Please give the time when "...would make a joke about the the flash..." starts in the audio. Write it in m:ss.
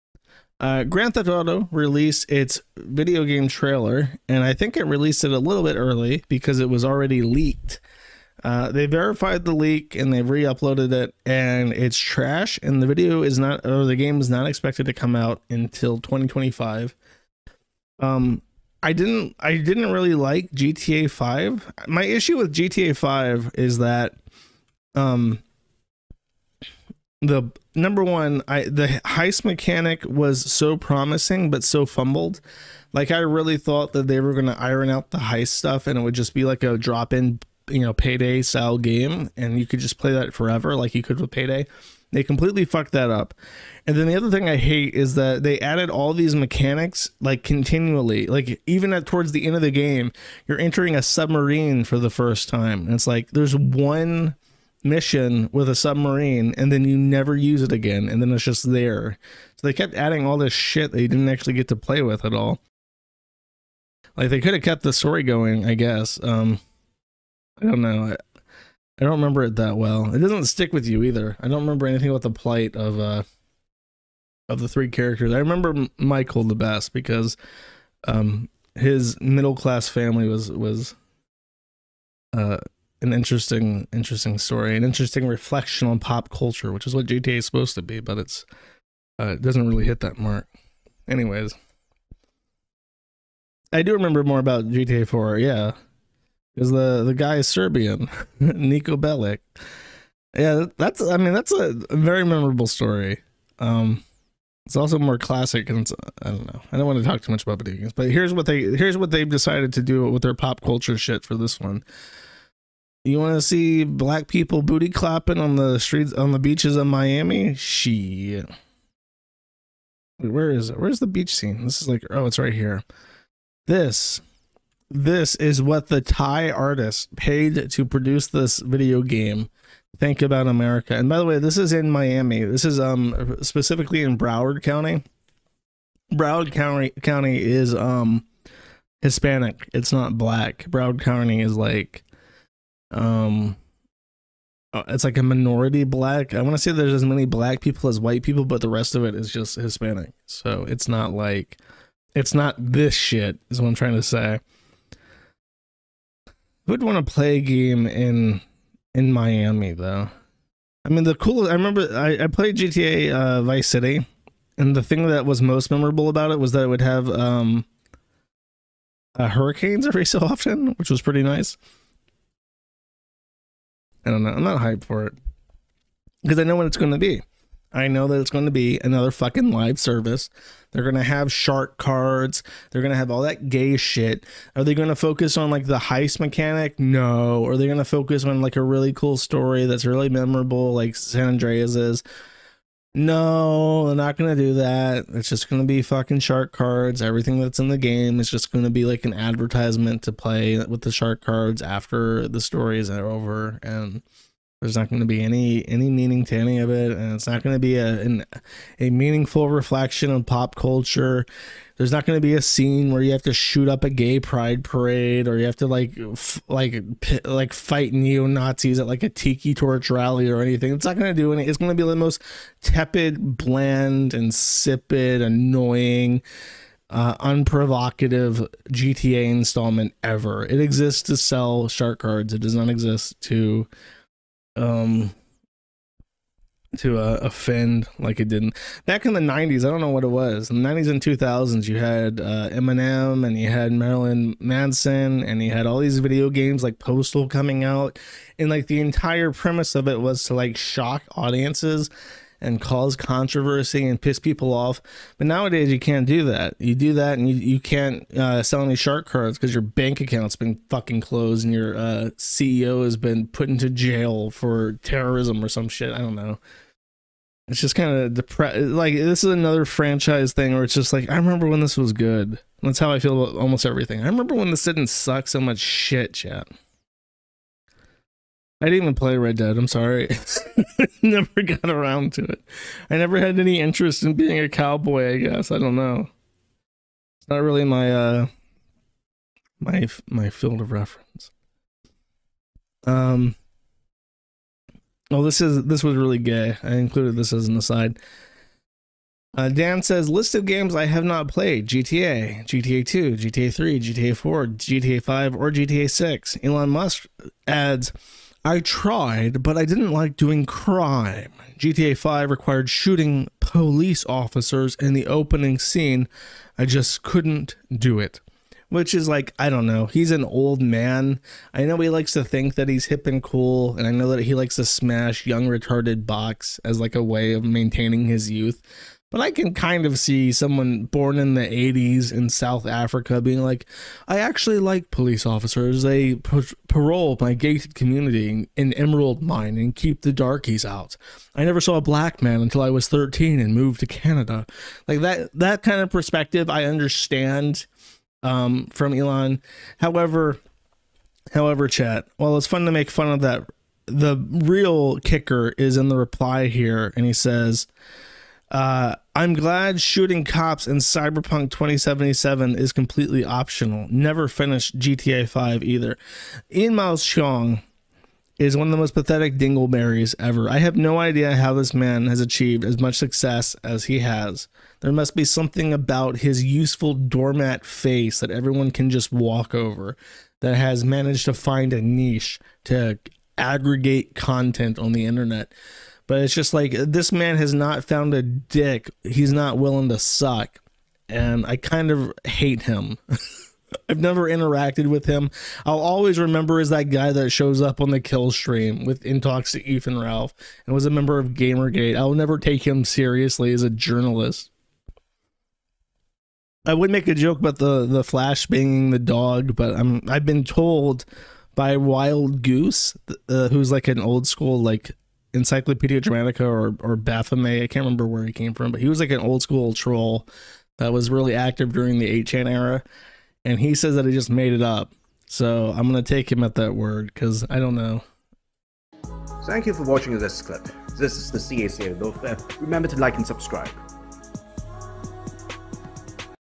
6:46.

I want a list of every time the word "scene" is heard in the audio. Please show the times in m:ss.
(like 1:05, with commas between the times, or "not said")
2:01, 3:32, 5:15.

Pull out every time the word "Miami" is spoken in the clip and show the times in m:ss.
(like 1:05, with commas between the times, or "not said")
1:56, 2:11, 2:39.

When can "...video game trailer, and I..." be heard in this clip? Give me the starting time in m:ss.
0:02.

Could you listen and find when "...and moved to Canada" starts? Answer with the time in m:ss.
5:43.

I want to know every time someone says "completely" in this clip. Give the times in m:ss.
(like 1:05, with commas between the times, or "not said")
0:42, 6:02.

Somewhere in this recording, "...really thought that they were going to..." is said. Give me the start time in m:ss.
0:33.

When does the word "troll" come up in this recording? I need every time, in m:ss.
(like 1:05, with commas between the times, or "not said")
6:59.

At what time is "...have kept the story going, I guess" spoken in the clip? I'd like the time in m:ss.
1:04.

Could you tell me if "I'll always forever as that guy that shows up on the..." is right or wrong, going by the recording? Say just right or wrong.
wrong.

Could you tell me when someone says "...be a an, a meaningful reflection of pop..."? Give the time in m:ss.
3:27.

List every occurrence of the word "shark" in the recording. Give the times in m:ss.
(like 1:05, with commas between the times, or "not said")
3:01, 3:16, 3:20, 3:51, 4:18.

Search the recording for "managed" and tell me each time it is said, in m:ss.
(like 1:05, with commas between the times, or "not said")
6:20.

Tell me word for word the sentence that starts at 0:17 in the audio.
Um, I didn't, I didn't really like GTA 5.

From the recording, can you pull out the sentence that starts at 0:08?
Uh, they verified the leak and they re-uploaded it, and it's trash.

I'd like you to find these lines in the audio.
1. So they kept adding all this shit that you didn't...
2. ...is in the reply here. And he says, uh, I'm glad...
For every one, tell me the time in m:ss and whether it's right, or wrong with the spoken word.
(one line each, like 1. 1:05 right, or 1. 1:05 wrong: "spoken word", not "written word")
1. 0:59 right
2. 5:55 right.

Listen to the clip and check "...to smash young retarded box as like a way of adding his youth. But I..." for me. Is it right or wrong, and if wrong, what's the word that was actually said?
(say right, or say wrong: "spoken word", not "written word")
wrong: "maintaining", not "adding".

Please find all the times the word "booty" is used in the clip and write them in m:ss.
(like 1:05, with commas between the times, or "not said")
1:54.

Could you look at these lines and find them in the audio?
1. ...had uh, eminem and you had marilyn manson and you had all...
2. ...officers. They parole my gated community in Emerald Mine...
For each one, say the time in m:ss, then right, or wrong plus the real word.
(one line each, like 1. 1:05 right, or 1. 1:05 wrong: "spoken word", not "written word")
1. 4:01 right
2. 5:35 right.